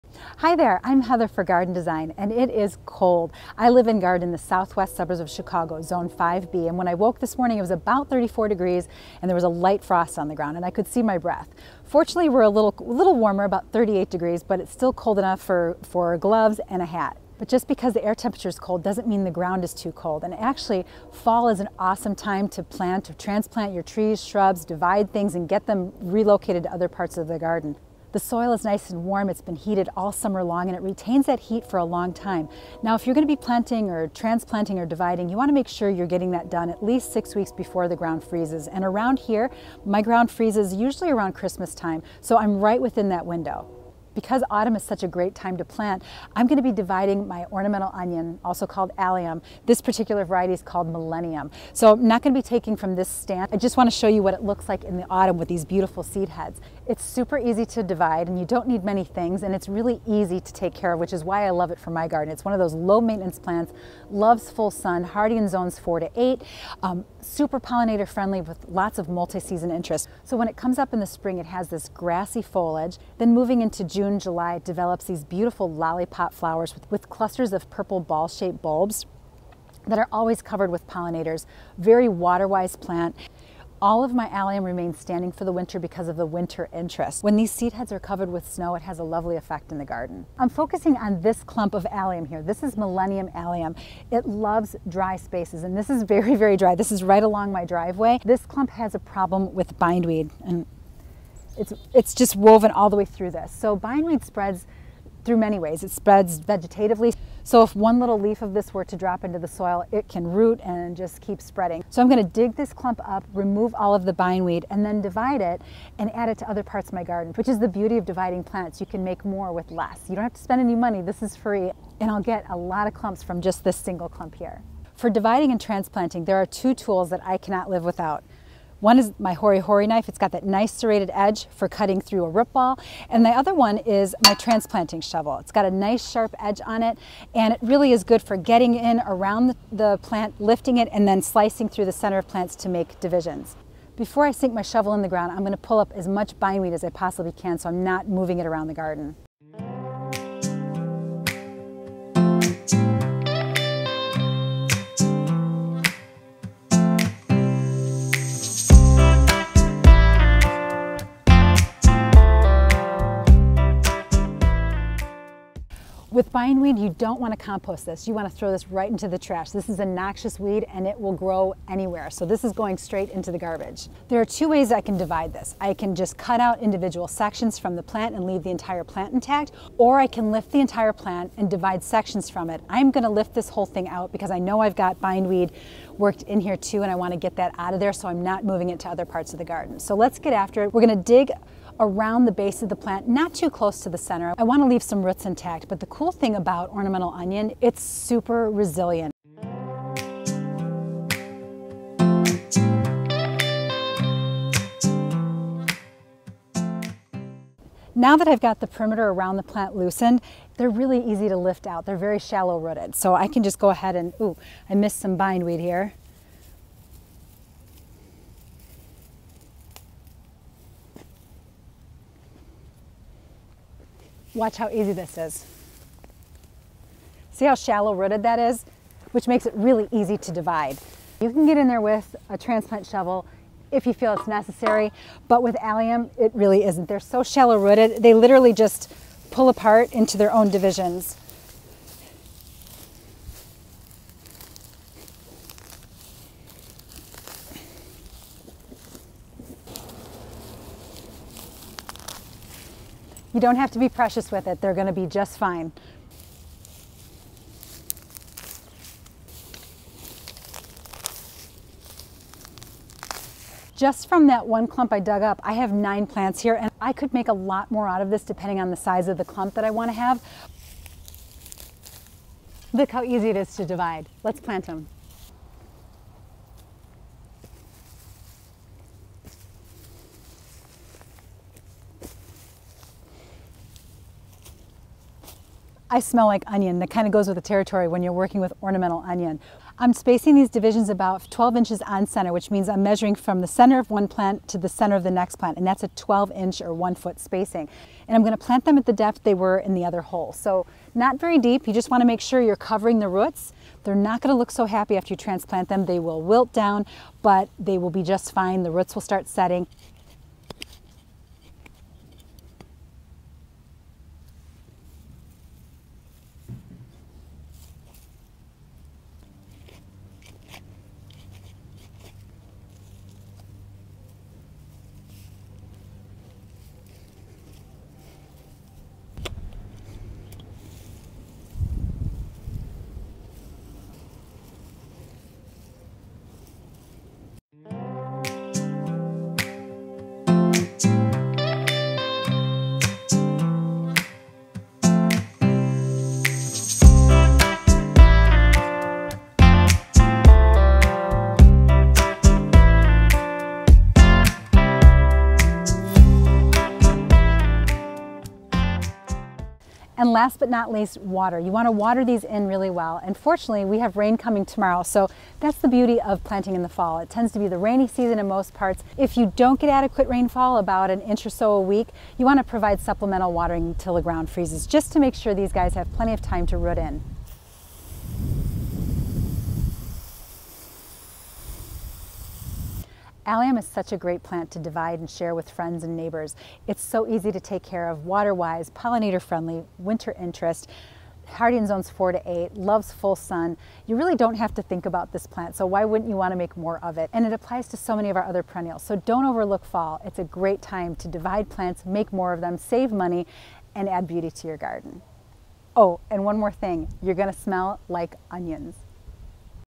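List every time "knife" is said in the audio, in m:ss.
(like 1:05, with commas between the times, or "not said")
2:09.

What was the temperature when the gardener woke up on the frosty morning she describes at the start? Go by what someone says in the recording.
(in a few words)
34 degrees.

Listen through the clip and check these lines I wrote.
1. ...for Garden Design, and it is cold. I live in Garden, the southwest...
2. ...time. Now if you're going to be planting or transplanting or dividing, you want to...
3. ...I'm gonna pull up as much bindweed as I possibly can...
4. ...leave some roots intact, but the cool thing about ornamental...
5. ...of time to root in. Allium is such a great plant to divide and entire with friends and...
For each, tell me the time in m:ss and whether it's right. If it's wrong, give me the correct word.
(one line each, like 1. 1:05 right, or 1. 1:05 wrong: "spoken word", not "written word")
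1. 0:01 right
2. 0:32 right
3. 2:25 right
4. 3:14 right
5. 6:16 wrong: "share", not "entire".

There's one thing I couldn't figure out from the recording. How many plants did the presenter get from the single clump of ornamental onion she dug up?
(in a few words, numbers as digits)
9.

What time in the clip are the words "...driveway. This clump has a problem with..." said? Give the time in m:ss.
1:37.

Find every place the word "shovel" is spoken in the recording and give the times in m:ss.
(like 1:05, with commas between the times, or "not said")
2:15, 2:24, 3:52.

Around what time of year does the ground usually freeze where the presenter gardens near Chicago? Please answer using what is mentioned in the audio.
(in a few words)
Christmas.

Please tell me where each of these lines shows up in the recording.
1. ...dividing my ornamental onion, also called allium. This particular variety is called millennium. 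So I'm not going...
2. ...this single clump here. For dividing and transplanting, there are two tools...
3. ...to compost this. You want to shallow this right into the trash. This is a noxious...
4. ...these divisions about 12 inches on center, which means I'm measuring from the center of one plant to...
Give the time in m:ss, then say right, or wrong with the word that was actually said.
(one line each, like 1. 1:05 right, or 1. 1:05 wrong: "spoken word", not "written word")
1. 0:46 right
2. 2:03 right
3. 2:47 wrong: "throw", not "shallow"
4. 4:50 right.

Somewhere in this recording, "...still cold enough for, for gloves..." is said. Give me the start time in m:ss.
0:14.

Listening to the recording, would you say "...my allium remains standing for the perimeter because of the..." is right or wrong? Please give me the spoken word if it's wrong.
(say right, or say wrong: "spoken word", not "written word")
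wrong: "winter", not "perimeter".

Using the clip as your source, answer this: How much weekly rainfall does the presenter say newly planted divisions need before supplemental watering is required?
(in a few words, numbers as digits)
about an inch.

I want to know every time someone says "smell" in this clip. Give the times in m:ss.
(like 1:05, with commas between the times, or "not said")
4:45, 6:47.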